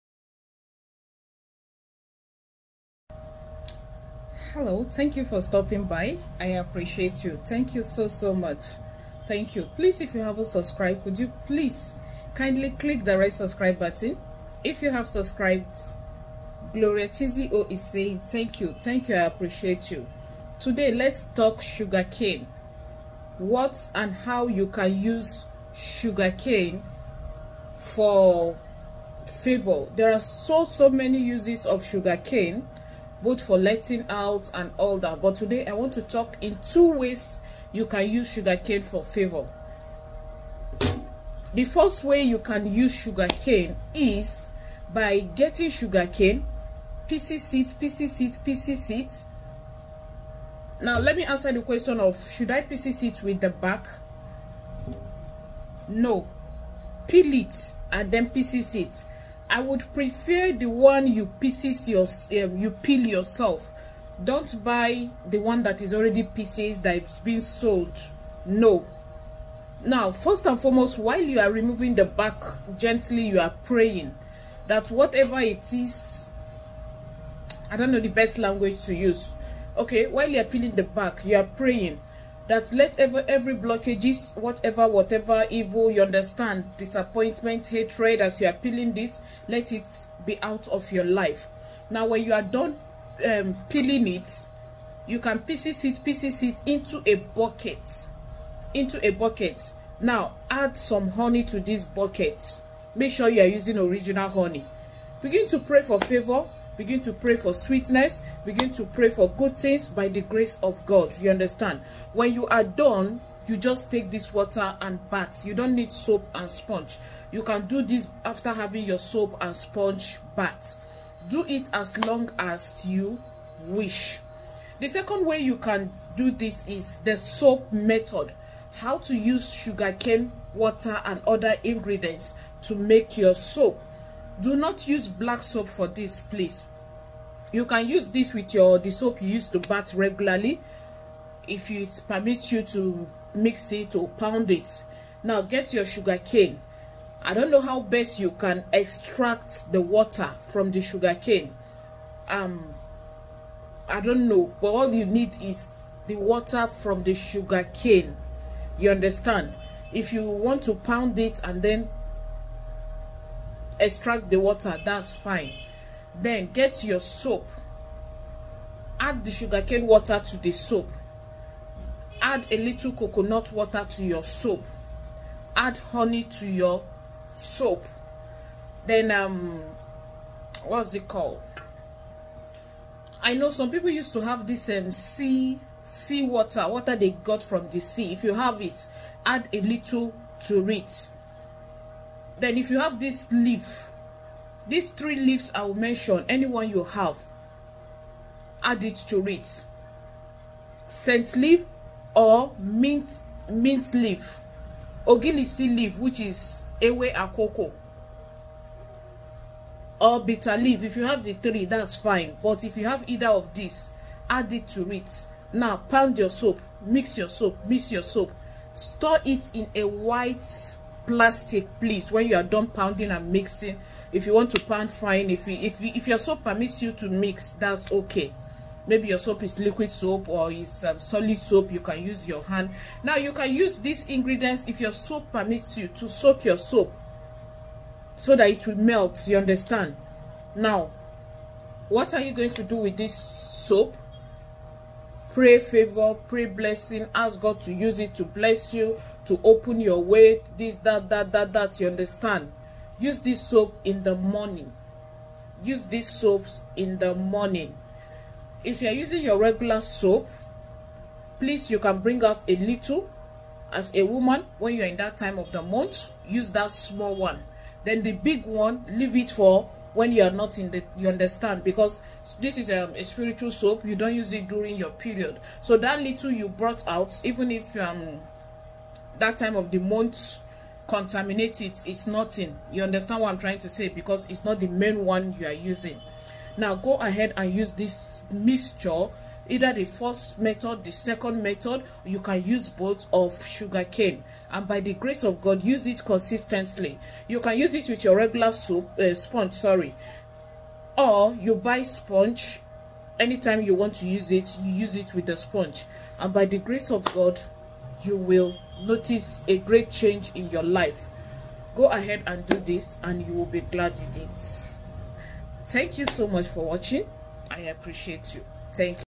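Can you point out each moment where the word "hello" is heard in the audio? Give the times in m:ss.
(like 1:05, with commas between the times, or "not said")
0:04.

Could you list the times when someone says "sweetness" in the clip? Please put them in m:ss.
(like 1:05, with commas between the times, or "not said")
1:47.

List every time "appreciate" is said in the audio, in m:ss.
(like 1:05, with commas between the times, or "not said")
0:06, 0:19, 5:17.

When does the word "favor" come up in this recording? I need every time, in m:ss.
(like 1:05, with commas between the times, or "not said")
0:29, 0:39, 1:46, 4:05.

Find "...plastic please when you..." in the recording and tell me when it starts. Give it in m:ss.
3:41.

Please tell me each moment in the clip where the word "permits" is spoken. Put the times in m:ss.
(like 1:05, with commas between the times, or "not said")
2:22, 3:46, 3:55.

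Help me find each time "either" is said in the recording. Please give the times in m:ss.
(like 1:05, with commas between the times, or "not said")
3:33, 4:49.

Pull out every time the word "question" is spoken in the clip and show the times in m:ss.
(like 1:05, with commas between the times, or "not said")
0:51.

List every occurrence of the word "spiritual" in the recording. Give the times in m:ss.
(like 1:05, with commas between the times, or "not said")
4:33.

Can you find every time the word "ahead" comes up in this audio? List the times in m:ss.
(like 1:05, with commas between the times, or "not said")
4:46, 5:11.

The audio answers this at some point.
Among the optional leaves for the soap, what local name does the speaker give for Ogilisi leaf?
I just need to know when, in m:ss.
3:26.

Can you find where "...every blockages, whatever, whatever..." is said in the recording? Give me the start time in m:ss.
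1:23.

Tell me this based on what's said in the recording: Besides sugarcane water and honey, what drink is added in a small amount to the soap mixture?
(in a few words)
coconut water.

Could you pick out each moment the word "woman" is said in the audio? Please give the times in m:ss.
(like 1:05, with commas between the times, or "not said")
4:24.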